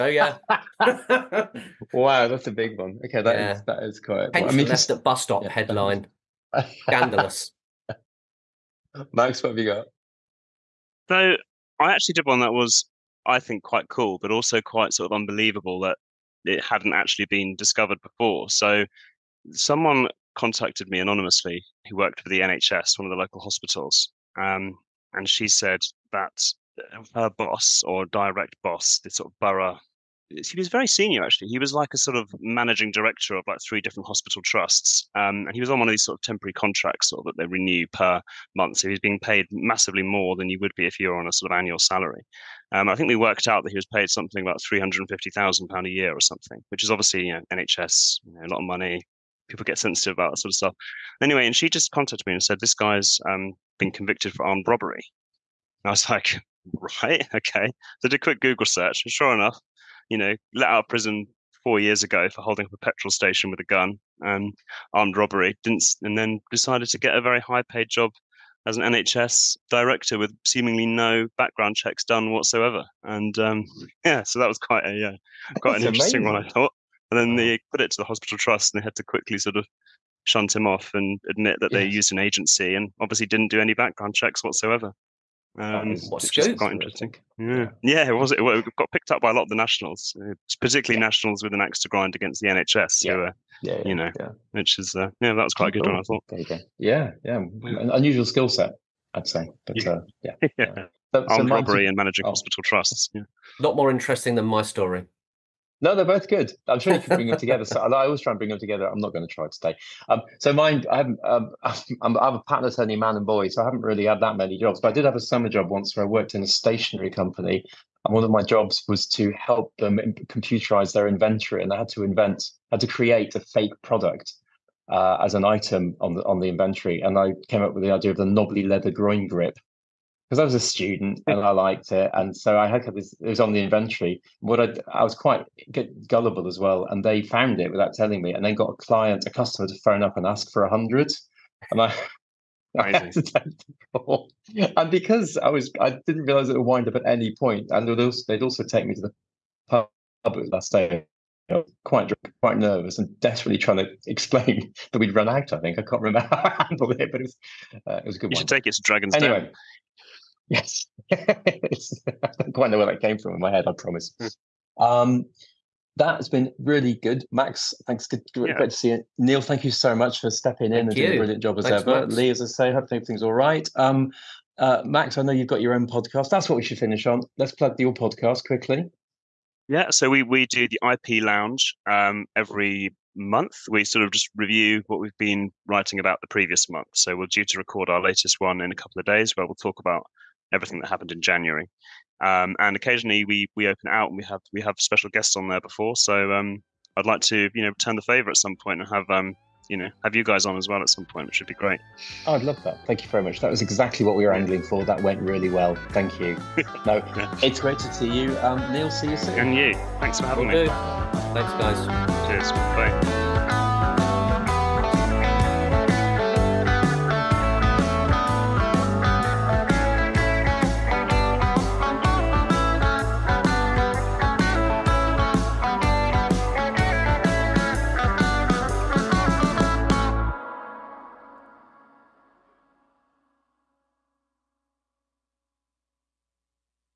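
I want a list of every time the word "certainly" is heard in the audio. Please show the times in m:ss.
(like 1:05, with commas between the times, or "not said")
not said.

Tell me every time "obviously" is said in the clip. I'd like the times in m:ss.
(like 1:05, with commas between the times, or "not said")
0:46, 1:22.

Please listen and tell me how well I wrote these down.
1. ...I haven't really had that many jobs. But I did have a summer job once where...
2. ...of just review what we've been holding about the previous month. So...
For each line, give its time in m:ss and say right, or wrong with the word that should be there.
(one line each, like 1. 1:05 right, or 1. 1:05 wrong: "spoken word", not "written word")
1. 1:53 right
2. 3:04 wrong: "writing", not "holding".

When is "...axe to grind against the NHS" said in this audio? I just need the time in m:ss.
1:31.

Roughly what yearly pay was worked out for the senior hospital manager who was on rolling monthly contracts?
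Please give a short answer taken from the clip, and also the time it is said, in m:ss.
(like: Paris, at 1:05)
£350,000, at 0:44.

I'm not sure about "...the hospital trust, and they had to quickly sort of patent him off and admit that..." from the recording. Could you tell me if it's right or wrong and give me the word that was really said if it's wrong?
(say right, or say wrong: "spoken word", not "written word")
wrong: "shunt", not "patent".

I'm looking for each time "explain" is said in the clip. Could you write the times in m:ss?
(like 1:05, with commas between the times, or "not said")
2:34.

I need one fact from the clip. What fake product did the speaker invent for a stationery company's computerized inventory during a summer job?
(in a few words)
Knobbly leather groin grip.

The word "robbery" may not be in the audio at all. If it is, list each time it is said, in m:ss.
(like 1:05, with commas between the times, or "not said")
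0:54, 1:05, 1:41.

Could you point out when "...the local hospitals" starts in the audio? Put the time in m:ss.
0:23.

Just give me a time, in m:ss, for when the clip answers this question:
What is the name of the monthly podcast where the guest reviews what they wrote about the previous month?
3:00.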